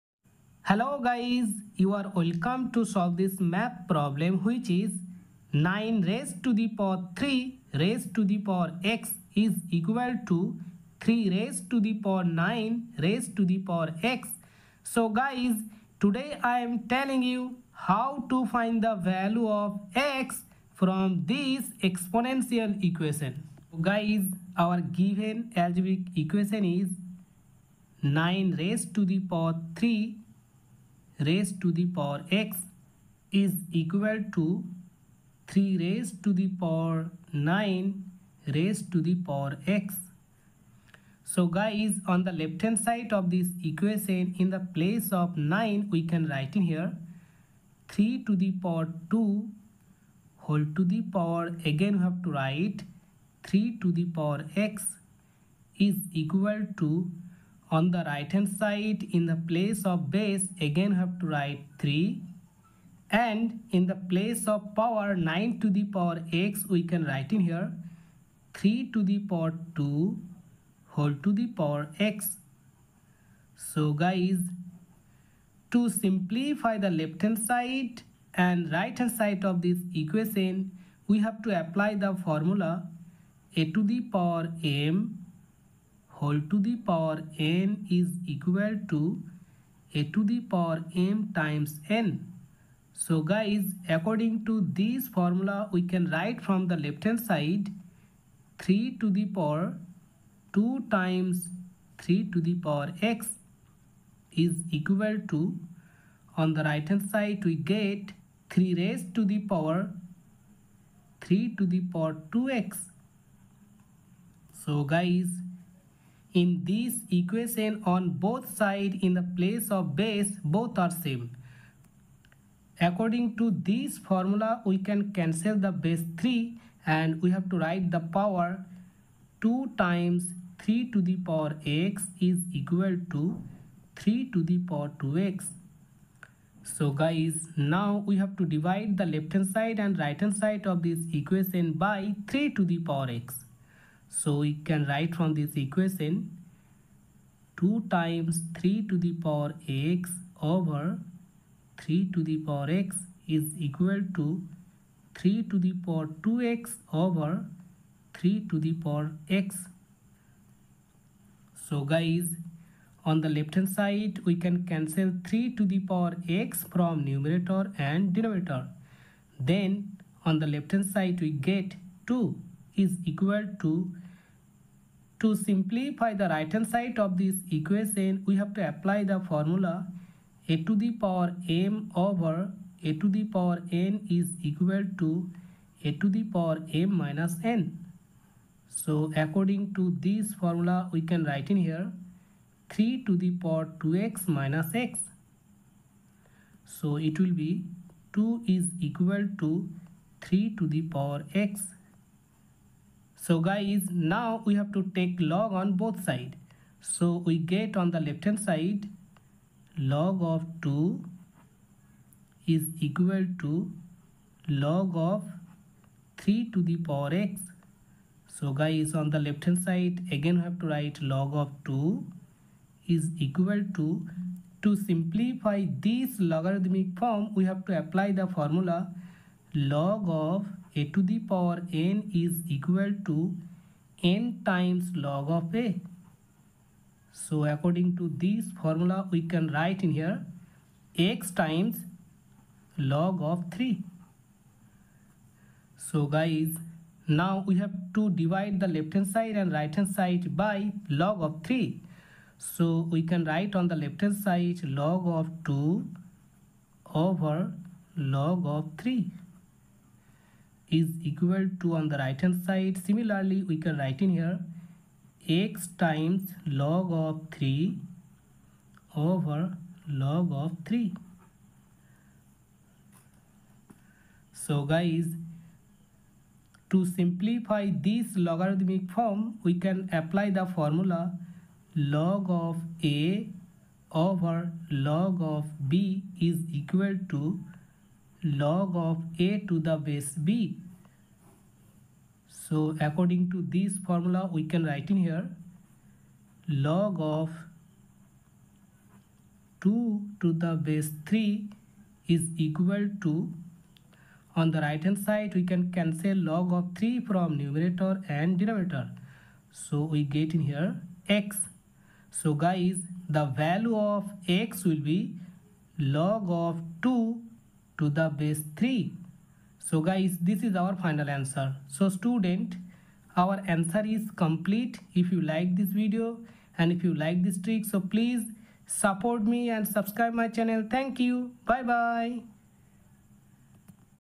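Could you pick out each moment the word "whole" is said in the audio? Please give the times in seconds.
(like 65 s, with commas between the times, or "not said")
50 s, 70 s, 86 s.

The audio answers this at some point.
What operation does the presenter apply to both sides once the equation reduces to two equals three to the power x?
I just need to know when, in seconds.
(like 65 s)
204 s.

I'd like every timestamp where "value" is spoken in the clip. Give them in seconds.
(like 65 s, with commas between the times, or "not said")
18 s, 313 s.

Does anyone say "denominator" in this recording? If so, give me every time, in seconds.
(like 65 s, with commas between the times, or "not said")
168 s, 308 s.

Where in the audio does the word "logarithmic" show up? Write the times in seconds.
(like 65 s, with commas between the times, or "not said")
226 s, 278 s.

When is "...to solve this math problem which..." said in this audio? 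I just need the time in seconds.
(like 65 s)
2 s.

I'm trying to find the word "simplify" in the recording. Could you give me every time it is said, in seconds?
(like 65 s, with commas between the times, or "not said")
75 s, 175 s, 224 s, 276 s.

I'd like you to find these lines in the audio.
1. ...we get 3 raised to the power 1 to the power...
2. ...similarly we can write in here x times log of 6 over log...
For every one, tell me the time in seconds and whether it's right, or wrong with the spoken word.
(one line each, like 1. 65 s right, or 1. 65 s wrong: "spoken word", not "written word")
1. 107 s wrong: "3", not "1"
2. 262 s wrong: "3", not "6".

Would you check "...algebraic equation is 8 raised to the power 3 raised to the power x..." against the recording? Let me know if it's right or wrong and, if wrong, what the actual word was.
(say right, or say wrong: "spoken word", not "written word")
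wrong: "9", not "8".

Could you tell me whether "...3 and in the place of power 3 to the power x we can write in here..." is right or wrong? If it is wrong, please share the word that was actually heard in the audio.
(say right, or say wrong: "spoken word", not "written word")
wrong: "9", not "3".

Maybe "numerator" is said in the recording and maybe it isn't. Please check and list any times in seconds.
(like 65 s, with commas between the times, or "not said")
167 s, 307 s.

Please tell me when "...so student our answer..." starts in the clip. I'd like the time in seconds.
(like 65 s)
321 s.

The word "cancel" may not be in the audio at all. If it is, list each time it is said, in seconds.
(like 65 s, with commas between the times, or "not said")
125 s, 164 s, 305 s.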